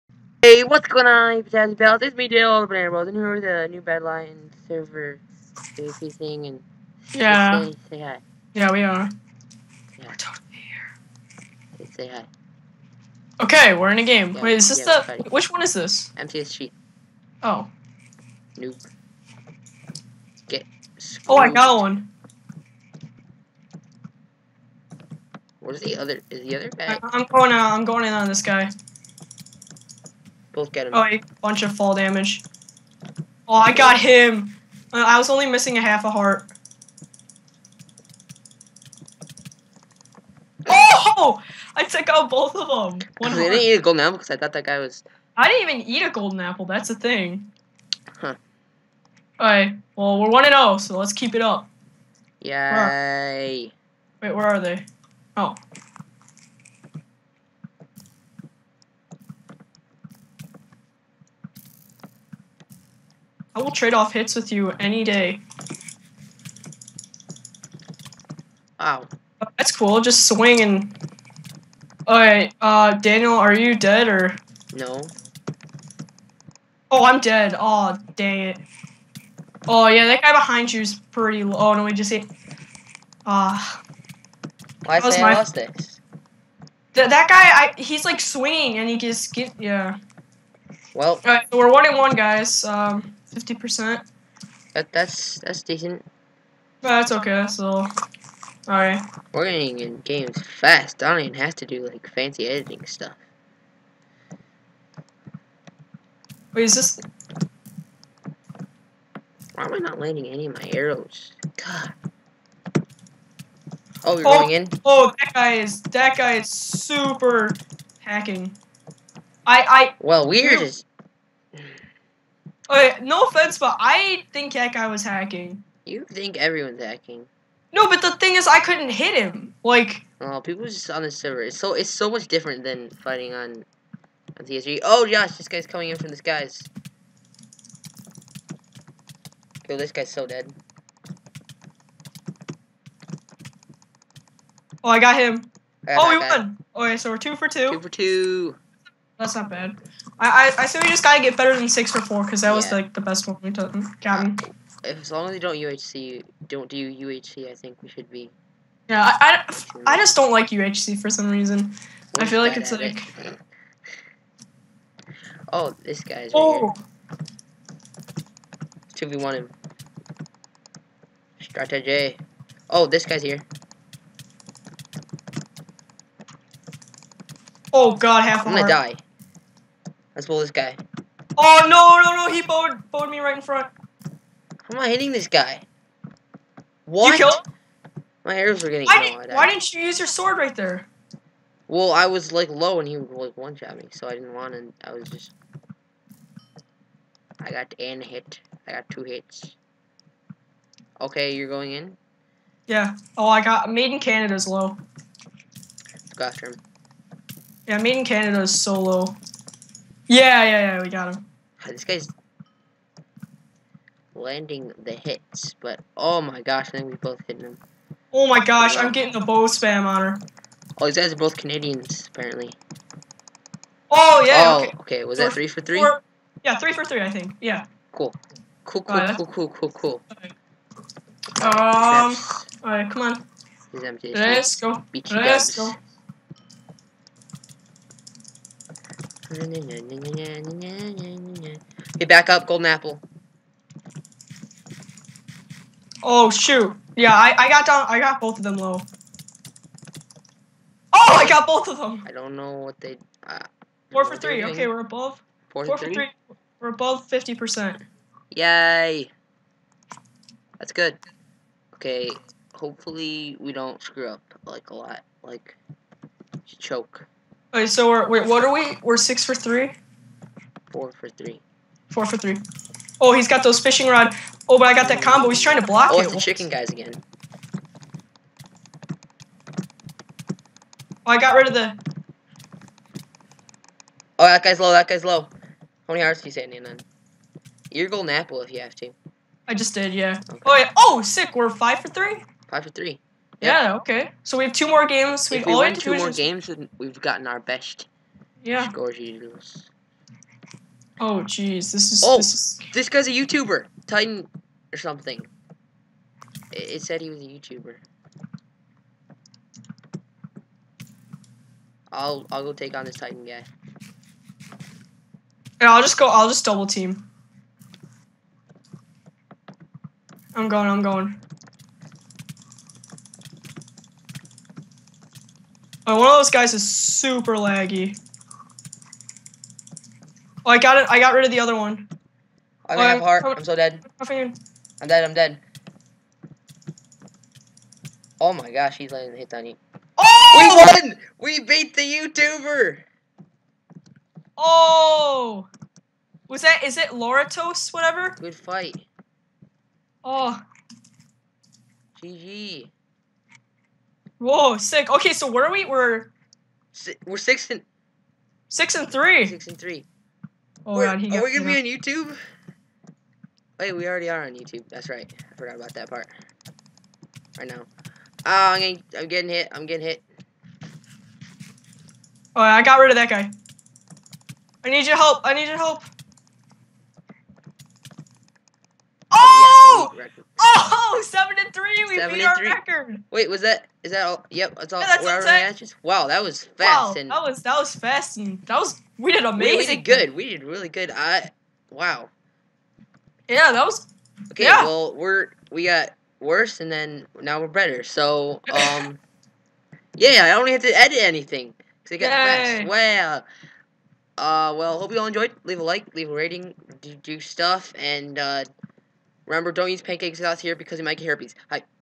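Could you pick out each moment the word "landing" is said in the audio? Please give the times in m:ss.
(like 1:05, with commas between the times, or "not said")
1:49, 3:34.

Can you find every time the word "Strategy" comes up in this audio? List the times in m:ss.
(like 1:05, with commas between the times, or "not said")
2:51.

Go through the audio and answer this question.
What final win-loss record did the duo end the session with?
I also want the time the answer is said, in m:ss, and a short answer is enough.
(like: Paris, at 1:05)
7 and 3, at 6:21.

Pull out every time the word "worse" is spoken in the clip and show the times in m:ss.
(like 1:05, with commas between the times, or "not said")
6:36.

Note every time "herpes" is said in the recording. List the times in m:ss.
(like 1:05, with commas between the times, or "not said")
6:51.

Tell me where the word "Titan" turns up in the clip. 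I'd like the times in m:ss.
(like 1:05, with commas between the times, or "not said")
5:03, 5:12.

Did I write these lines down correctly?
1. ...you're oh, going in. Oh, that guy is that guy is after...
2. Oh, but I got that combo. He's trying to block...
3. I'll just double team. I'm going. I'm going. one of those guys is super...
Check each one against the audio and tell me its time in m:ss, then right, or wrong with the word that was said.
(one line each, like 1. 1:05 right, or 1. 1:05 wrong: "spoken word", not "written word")
1. 1:54 wrong: "super", not "after"
2. 4:34 right
3. 5:16 right.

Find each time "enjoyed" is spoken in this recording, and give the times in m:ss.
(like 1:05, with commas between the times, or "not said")
6:45.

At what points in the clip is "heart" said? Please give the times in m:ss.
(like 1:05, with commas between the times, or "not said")
0:36, 2:58, 4:46, 5:33.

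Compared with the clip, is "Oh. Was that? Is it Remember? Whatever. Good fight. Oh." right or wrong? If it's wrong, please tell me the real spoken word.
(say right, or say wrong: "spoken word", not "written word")
wrong: "Loratos", not "Remember".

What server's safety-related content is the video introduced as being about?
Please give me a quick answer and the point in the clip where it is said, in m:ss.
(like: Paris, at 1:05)
Badlion, at 0:03.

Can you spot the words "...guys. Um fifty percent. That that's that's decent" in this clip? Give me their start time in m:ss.
1:32.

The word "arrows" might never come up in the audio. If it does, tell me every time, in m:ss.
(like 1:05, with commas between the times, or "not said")
1:50, 3:08.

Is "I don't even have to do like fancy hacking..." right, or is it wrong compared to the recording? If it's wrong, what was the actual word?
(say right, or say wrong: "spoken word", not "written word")
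wrong: "editing", not "hacking".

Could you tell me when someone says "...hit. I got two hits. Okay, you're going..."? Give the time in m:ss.
3:18.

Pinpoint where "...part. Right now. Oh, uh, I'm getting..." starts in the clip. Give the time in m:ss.
6:05.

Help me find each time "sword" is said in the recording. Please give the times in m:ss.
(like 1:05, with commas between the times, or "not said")
3:10.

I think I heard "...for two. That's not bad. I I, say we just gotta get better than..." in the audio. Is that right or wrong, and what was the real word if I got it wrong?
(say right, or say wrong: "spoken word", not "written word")
right.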